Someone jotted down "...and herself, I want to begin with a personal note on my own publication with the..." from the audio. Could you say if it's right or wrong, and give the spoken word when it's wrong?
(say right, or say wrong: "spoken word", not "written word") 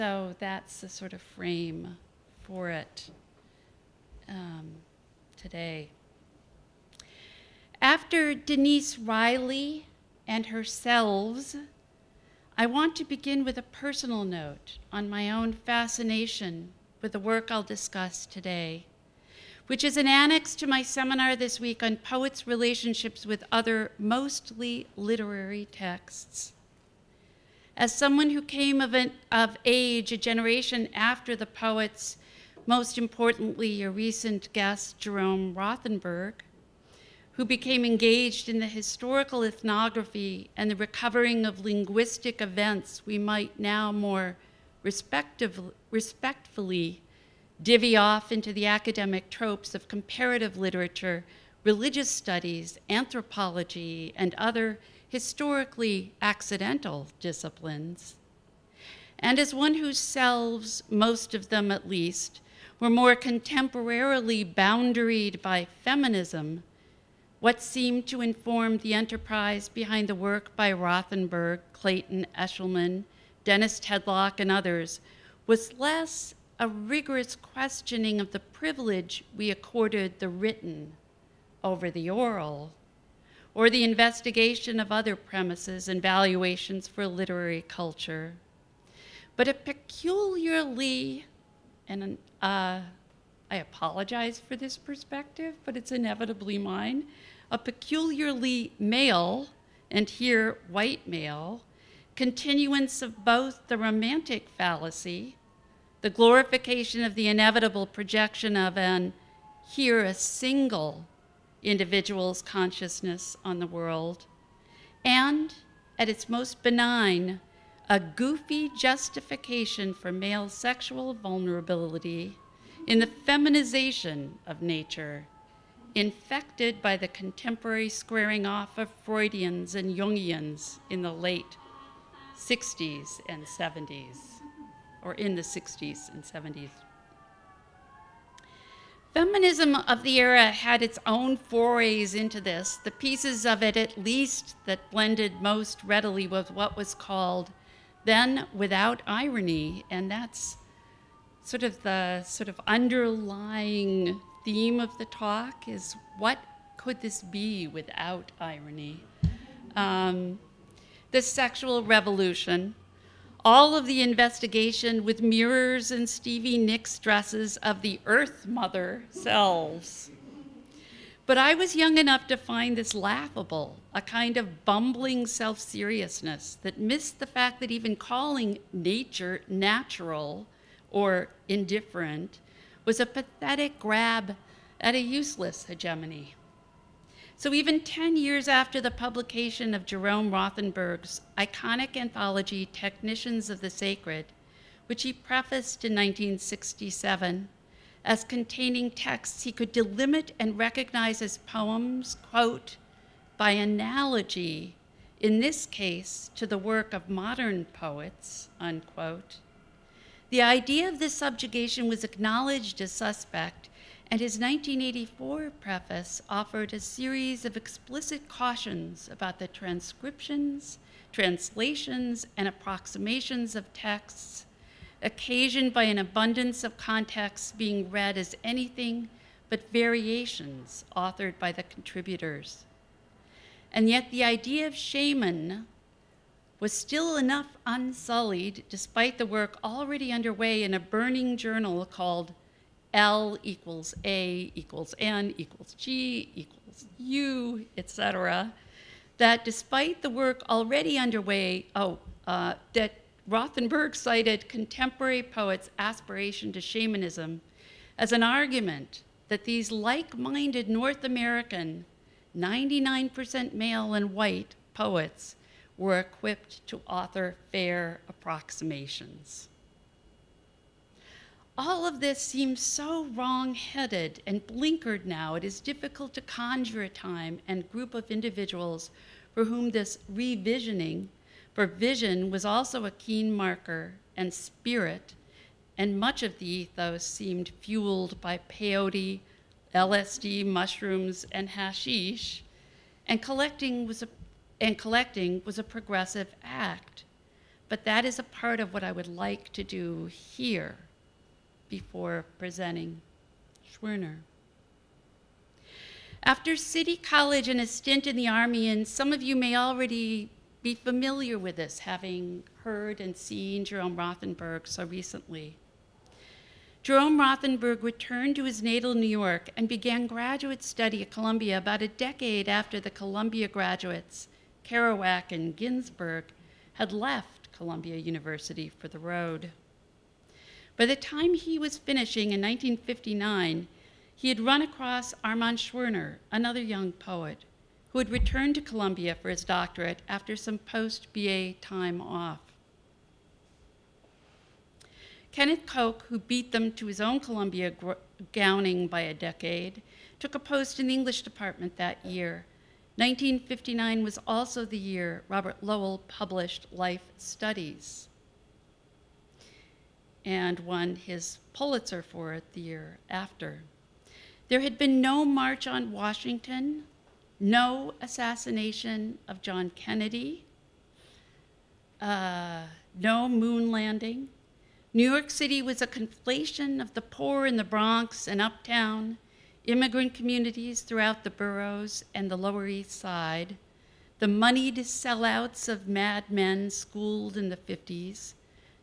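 wrong: "fascination", not "publication".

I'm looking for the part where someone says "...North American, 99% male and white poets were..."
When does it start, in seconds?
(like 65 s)
260 s.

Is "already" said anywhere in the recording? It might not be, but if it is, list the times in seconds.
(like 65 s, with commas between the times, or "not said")
239 s, 250 s, 309 s.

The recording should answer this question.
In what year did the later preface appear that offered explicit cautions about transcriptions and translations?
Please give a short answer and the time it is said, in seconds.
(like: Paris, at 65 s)
1984, at 214 s.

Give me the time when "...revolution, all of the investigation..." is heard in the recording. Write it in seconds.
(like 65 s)
161 s.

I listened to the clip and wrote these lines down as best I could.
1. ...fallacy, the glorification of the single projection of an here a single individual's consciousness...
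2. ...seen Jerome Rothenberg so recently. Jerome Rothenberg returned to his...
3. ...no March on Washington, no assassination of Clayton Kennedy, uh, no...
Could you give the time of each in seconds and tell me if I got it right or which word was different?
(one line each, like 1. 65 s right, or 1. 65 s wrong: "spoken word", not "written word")
1. 104 s wrong: "inevitable", not "single"
2. 313 s right
3. 364 s wrong: "John", not "Clayton".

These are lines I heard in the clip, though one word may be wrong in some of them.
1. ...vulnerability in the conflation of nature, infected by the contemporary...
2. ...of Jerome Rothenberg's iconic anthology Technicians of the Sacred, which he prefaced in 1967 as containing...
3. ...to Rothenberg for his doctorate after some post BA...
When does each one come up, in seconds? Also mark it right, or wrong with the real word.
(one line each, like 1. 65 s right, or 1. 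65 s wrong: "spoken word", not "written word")
1. 121 s wrong: "feminization", not "conflation"
2. 189 s right
3. 338 s wrong: "Columbia", not "Rothenberg".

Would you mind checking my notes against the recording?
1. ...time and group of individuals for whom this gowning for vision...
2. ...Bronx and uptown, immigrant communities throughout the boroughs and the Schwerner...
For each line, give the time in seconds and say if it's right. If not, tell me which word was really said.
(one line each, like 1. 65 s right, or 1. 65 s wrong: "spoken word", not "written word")
1. 276 s wrong: "revisioning", not "gowning"
2. 377 s wrong: "Lower", not "Schwerner".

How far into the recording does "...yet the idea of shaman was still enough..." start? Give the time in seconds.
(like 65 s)
233 s.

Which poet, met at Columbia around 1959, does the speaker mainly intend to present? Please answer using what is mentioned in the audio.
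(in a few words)
Armand Schwerner.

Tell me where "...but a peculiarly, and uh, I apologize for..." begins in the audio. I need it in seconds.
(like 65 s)
89 s.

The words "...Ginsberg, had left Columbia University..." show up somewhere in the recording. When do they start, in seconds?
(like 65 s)
325 s.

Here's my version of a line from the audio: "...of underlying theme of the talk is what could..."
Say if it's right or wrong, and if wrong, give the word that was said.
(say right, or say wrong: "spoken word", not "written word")
right.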